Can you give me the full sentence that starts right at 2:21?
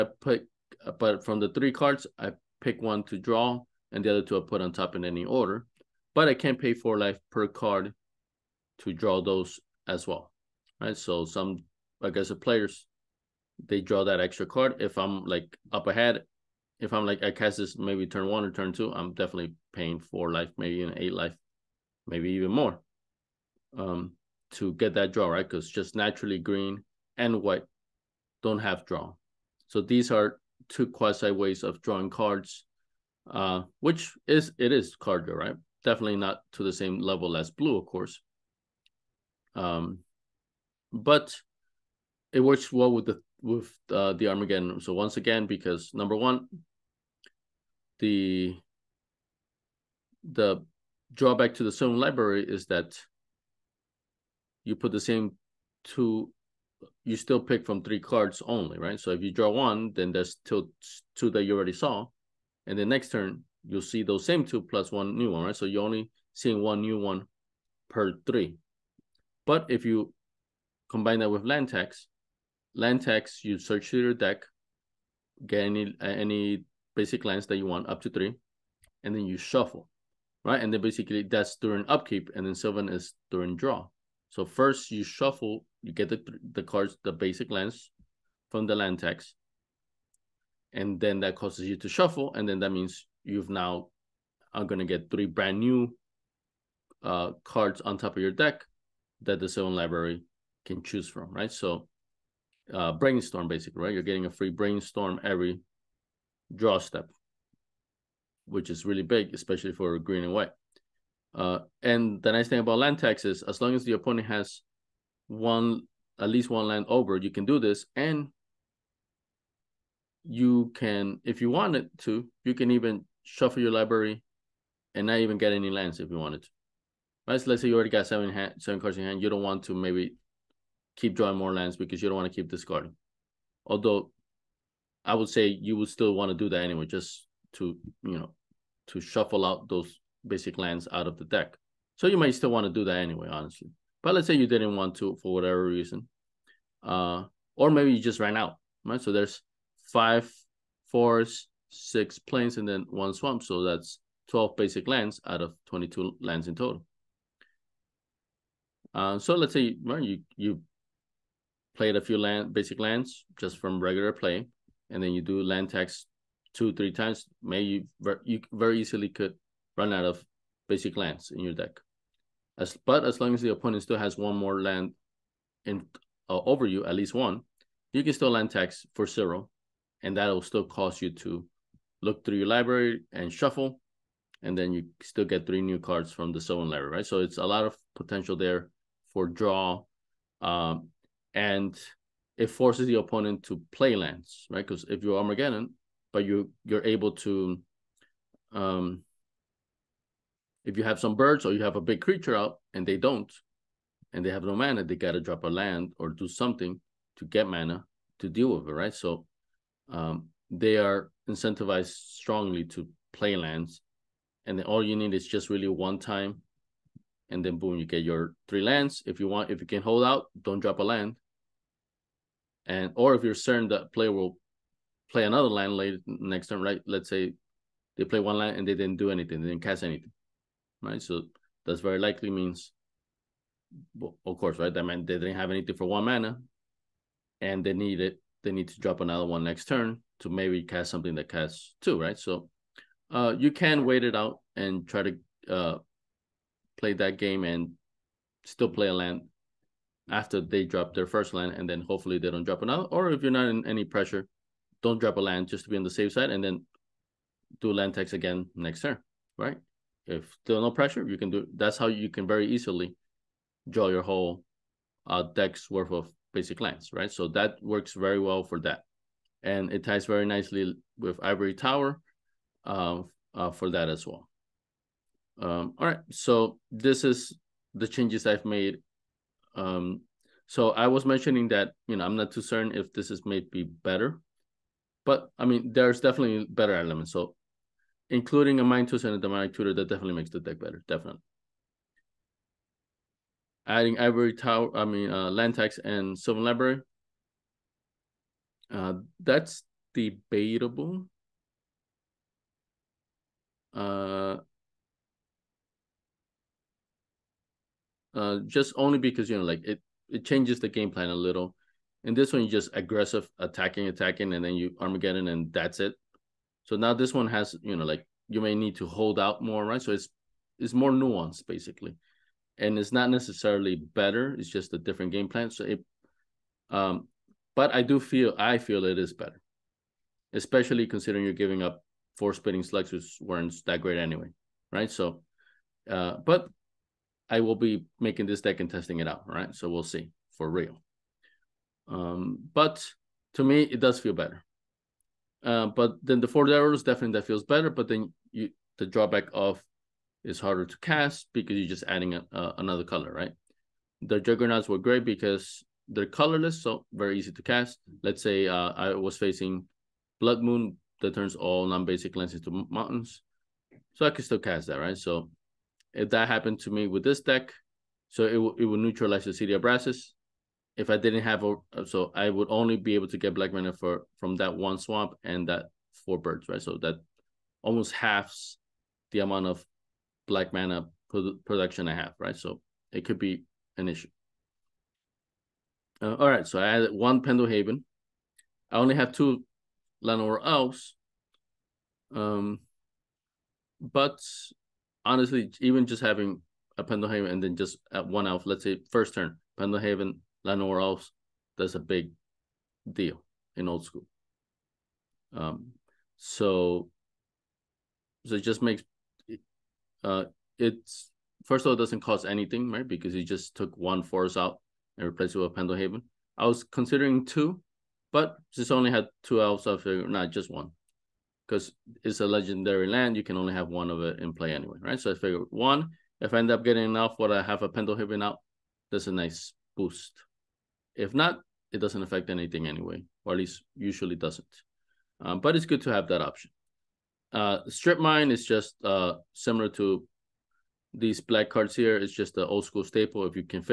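So you might still want to do that anyway, honestly.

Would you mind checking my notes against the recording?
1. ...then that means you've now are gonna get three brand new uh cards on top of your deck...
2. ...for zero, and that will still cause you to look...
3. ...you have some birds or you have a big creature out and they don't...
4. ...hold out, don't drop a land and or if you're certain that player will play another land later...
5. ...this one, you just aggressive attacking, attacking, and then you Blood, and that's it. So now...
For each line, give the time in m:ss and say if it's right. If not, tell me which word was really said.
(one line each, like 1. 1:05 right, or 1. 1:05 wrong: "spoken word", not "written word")
1. 1:32 right
2. 2:58 right
3. 3:20 right
4. 3:39 right
5. 5:12 wrong: "Armageddon", not "Blood".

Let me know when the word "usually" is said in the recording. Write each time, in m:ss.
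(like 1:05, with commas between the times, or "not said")
7:13.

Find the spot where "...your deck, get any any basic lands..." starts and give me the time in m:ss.
1:14.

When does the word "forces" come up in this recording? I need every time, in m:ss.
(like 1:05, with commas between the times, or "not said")
3:12, 6:54.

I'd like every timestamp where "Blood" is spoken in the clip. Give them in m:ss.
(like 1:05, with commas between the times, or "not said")
6:00.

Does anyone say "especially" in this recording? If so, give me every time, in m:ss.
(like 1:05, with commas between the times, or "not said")
1:49, 5:30.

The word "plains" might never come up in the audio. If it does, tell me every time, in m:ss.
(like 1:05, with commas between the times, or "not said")
2:32.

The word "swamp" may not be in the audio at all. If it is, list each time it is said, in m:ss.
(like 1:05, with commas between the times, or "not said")
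2:33, 6:14.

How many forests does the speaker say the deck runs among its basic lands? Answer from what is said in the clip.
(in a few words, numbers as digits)
5.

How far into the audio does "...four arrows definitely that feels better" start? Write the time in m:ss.
5:46.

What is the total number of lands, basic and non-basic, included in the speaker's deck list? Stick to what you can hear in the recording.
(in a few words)
22.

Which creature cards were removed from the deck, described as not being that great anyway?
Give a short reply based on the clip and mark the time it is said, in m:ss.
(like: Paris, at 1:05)
Spinning slugs, at 5:32.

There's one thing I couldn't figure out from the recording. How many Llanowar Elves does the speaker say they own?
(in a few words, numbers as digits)
2.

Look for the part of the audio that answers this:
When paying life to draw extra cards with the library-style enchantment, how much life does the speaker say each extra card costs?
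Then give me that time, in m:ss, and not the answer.
0:06.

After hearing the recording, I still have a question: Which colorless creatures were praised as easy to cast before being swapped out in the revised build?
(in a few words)
Juggernauts.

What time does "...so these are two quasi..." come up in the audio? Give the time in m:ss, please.
0:29.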